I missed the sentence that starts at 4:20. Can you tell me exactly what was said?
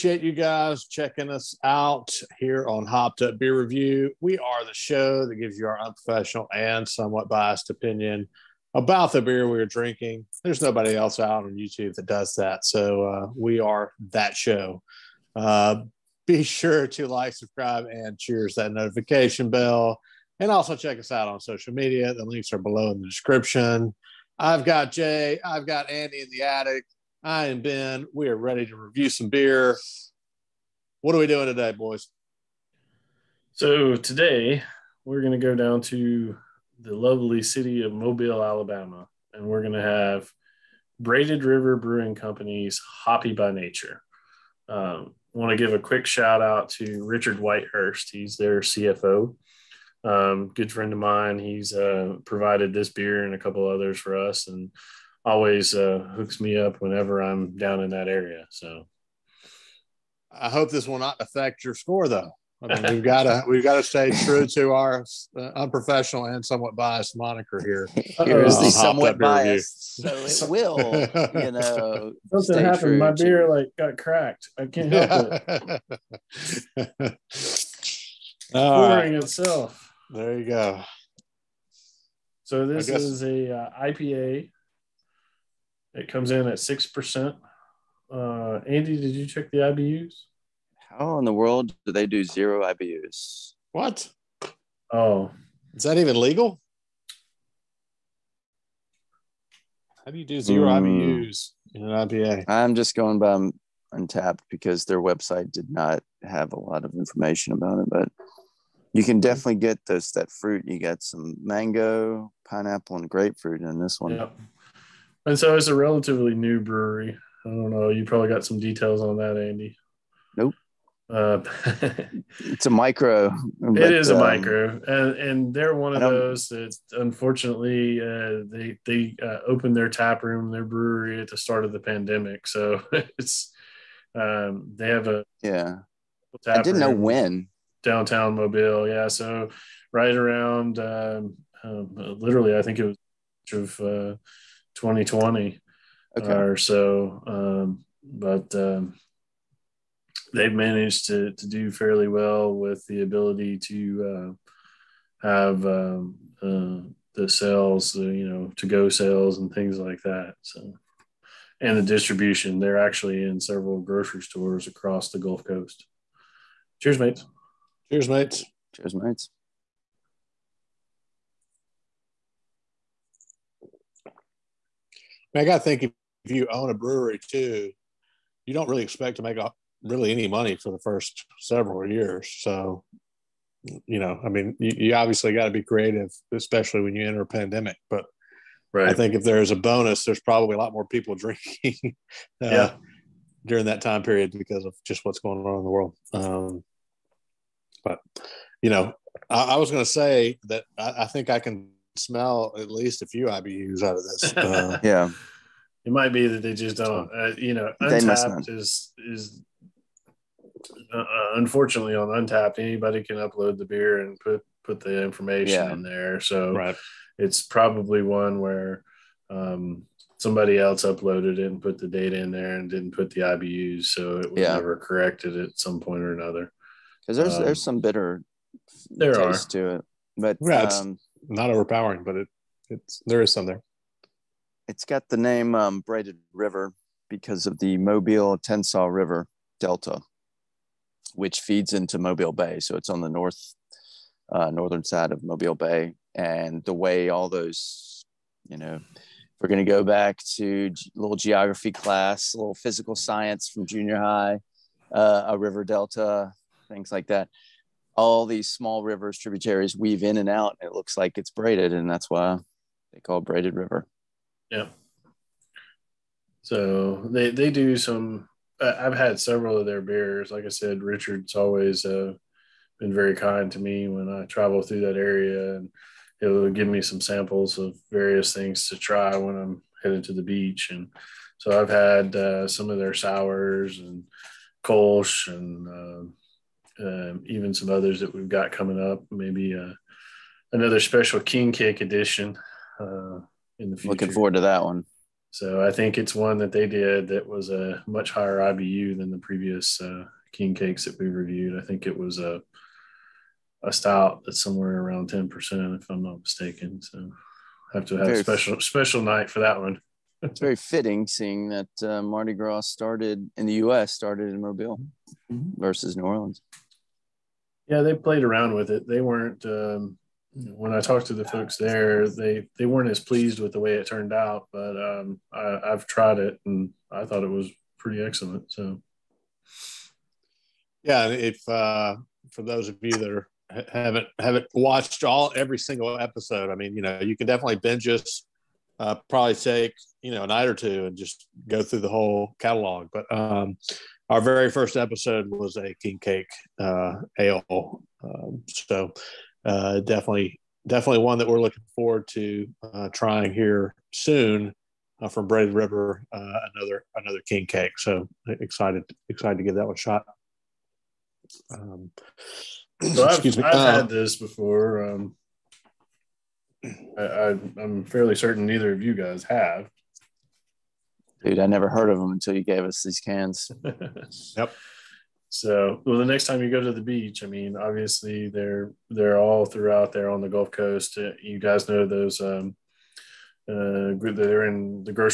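And it looks like it's braided, and that's why they call braided river.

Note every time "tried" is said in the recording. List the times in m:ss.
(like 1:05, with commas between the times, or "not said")
5:25.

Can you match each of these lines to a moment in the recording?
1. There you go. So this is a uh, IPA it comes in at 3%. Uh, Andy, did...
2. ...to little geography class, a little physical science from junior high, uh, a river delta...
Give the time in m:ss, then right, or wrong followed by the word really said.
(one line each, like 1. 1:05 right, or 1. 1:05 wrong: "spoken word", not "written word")
1. 1:20 wrong: "6", not "3"
2. 4:10 right.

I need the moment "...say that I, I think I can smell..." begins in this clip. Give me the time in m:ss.
3:19.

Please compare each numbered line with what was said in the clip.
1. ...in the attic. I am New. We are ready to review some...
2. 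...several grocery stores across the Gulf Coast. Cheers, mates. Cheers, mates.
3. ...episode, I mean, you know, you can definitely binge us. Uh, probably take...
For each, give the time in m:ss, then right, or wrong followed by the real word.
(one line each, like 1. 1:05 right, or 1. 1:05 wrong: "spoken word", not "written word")
1. 0:26 wrong: "Ben", not "New"
2. 2:43 right
3. 5:35 right.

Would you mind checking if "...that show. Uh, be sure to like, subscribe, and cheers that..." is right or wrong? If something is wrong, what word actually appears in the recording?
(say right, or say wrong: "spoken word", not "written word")
right.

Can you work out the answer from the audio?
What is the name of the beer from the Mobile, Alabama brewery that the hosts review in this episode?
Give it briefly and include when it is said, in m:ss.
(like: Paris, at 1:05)
Hoppy by Nature, at 0:43.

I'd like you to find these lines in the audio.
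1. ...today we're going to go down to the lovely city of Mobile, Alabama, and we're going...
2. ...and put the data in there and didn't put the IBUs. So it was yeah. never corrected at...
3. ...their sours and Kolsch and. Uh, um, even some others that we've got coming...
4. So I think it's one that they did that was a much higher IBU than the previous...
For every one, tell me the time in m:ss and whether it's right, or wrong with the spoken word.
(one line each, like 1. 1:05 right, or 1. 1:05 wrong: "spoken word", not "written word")
1. 0:33 right
2. 3:41 right
3. 4:42 right
4. 4:55 right.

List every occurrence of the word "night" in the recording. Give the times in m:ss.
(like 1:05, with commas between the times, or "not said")
5:09, 5:40.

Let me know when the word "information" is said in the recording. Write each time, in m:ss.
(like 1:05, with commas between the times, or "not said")
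1:46, 3:35.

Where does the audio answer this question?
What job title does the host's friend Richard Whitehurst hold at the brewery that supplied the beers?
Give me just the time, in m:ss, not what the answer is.
0:48.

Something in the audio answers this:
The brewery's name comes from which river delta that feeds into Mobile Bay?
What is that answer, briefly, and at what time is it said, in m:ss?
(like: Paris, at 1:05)
Mobile Tensaw River Delta, at 3:57.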